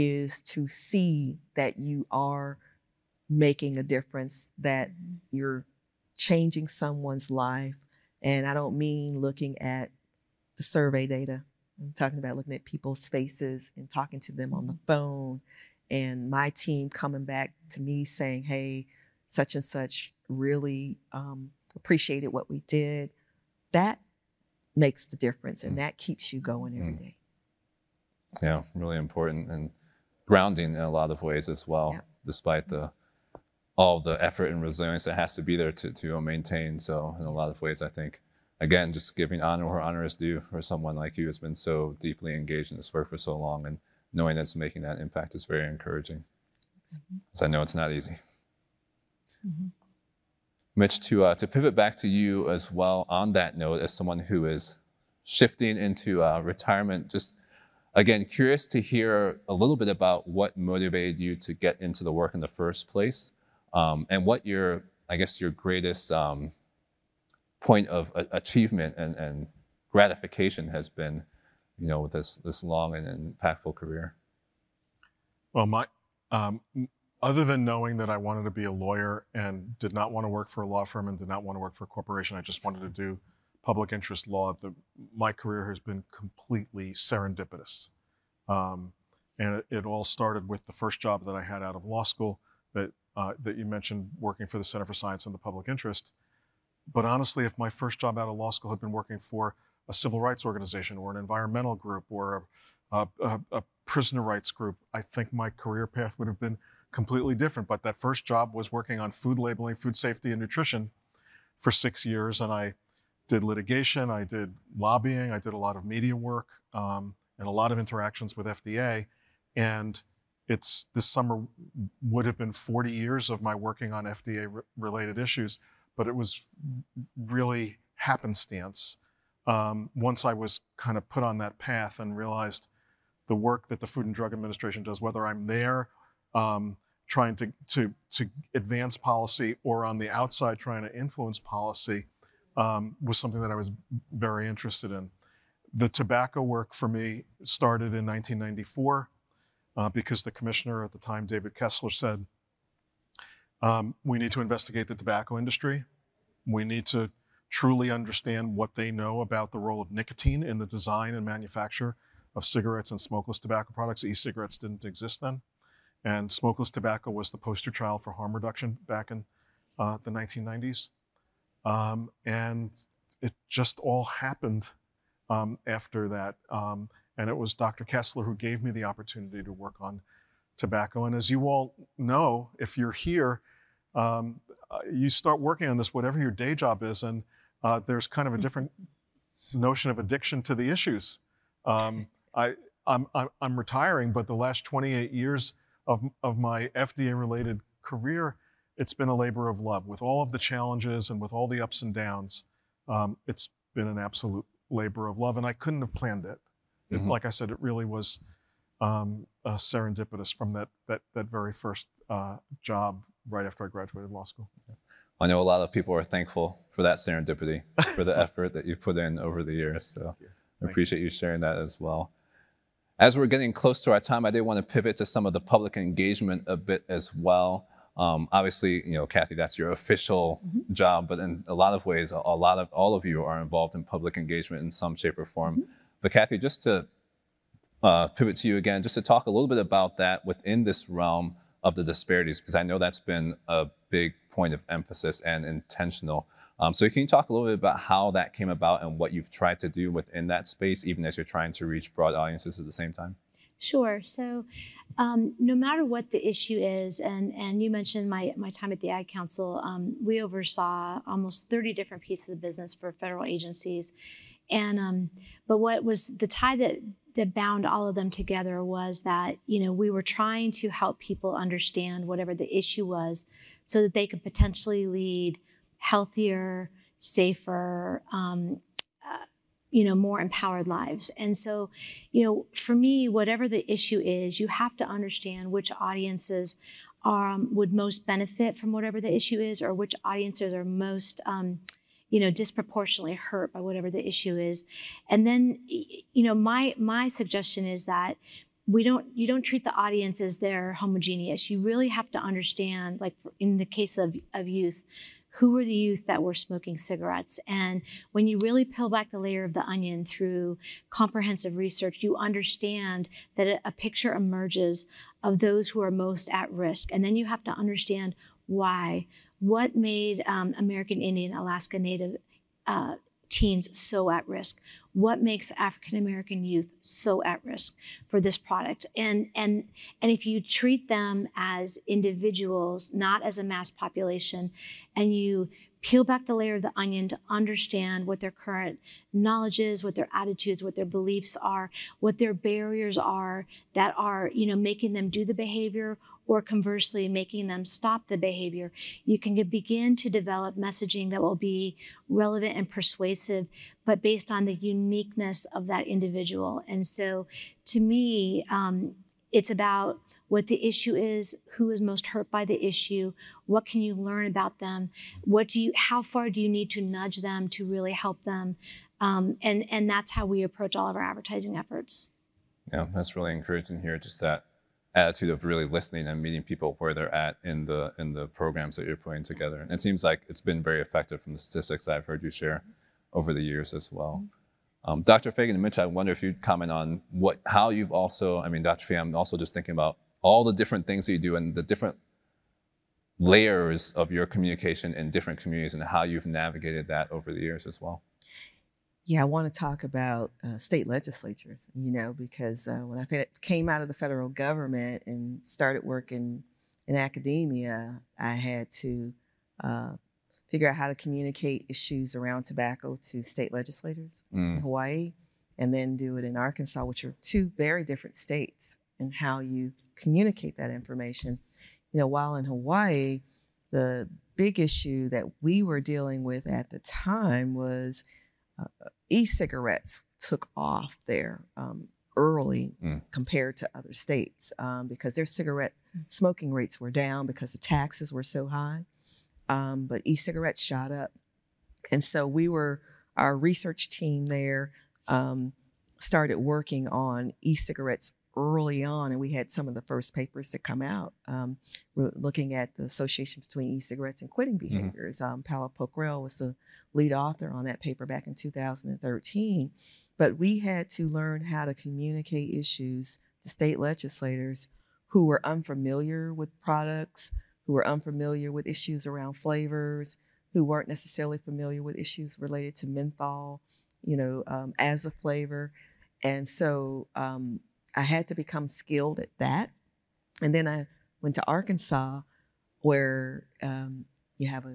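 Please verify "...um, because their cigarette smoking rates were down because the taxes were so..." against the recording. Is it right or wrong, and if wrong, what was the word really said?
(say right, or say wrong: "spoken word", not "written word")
right.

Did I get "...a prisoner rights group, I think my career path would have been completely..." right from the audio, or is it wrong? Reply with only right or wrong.
right.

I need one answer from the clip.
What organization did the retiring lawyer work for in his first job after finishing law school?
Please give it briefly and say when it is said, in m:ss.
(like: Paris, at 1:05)
Center for Science in the Public Interest, at 1:34.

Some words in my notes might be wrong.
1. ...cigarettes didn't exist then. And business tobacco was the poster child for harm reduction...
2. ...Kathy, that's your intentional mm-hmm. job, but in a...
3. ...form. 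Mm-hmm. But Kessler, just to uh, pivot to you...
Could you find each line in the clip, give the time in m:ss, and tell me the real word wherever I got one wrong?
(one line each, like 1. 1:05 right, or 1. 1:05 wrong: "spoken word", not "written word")
1. 2:44 wrong: "smokeless", not "business"
2. 3:49 wrong: "official", not "intentional"
3. 3:55 wrong: "Kathy", not "Kessler".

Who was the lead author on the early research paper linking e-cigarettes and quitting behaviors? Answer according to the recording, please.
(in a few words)
Pallav Pokhrel.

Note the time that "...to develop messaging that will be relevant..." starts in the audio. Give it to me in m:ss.
5:49.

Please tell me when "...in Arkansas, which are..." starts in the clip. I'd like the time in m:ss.
6:56.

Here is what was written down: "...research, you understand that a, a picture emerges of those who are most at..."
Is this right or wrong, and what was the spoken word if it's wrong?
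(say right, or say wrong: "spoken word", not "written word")
right.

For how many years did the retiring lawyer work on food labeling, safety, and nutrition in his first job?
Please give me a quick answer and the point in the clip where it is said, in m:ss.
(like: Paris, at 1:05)
6 years, at 1:51.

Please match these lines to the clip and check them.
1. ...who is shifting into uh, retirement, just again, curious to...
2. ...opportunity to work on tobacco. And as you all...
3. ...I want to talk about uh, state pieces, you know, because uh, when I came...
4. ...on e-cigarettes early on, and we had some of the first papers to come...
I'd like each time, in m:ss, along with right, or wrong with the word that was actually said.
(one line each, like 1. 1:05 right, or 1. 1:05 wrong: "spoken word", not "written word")
1. 0:54 right
2. 2:58 right
3. 6:39 wrong: "legislatures", not "pieces"
4. 7:26 right.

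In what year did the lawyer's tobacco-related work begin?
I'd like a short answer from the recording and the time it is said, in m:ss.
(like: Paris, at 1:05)
1994, at 2:28.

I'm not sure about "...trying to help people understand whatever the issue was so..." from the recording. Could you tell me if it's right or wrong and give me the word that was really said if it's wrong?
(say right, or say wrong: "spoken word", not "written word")
right.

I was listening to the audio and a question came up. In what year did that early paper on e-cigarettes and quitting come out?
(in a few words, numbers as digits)
2013.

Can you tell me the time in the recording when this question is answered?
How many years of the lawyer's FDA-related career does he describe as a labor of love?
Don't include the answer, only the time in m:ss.
3:14.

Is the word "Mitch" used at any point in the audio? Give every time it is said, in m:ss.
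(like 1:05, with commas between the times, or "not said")
0:50, 6:25.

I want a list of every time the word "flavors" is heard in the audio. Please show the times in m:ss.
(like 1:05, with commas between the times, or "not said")
7:49, 7:55.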